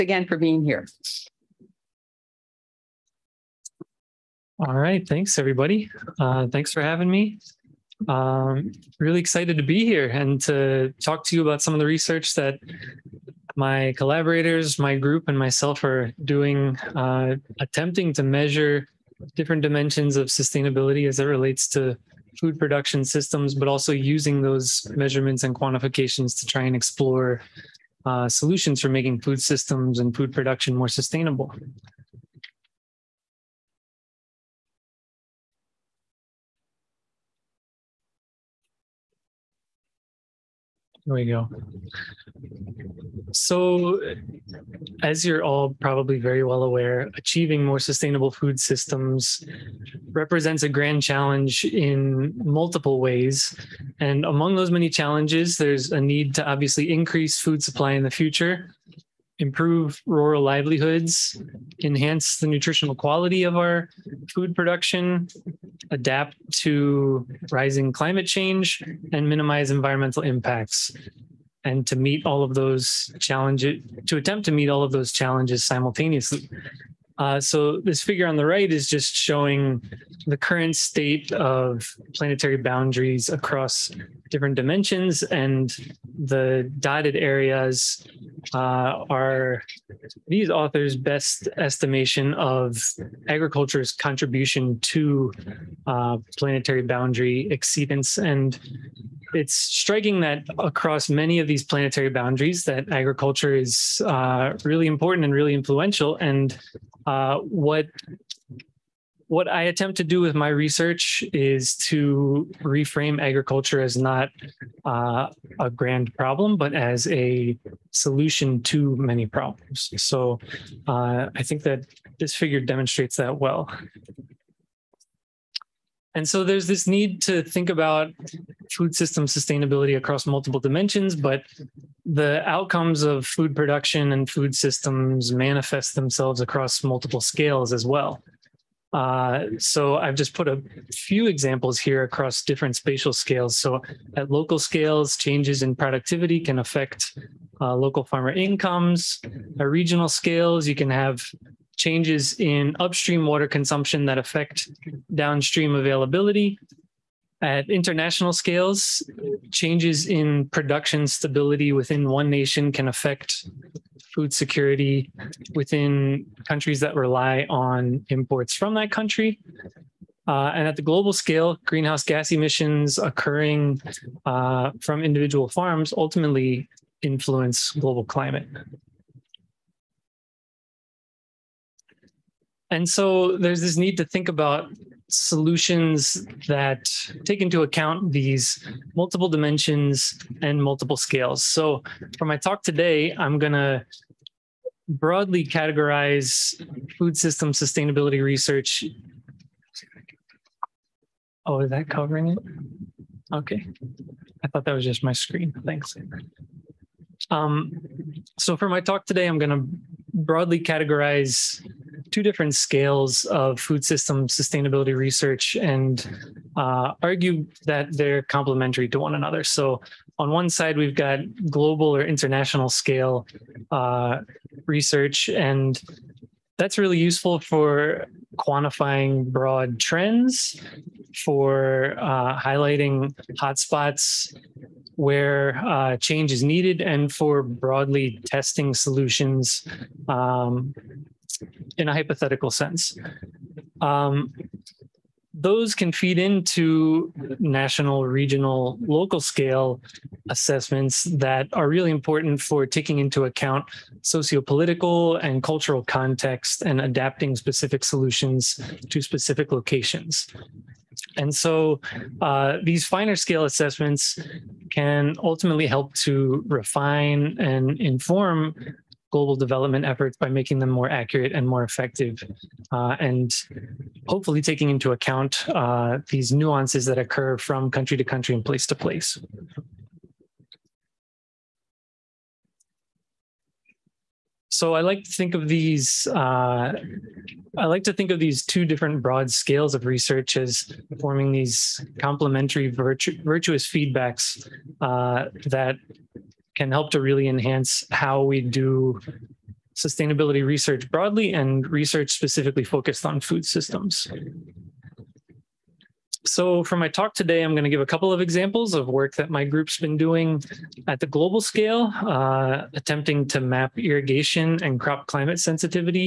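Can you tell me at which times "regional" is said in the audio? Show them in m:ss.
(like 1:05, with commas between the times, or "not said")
2:29, 4:08.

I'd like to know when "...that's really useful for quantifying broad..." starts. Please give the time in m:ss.
3:46.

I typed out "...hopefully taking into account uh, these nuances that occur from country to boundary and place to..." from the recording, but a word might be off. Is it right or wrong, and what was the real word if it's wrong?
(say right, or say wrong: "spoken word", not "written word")
wrong: "country", not "boundary".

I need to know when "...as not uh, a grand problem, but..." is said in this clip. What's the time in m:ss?
1:53.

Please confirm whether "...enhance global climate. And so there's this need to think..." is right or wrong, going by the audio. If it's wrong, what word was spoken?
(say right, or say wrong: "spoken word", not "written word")
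wrong: "influence", not "enhance".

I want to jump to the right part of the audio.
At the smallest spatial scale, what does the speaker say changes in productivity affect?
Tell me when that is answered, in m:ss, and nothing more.
2:27.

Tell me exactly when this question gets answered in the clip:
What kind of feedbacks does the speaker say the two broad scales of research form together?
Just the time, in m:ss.
4:53.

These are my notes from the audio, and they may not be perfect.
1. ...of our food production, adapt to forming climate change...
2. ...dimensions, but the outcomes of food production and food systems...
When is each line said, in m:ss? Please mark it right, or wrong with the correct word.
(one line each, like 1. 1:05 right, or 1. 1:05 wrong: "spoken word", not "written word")
1. 1:03 wrong: "rising", not "forming"
2. 2:10 right.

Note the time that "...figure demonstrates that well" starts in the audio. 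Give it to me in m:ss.
2:02.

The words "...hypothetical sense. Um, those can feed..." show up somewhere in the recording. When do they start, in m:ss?
4:01.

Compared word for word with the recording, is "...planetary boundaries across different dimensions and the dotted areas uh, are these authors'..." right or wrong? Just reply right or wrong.
right.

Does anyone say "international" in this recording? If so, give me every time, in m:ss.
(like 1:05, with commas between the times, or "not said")
2:37, 3:42.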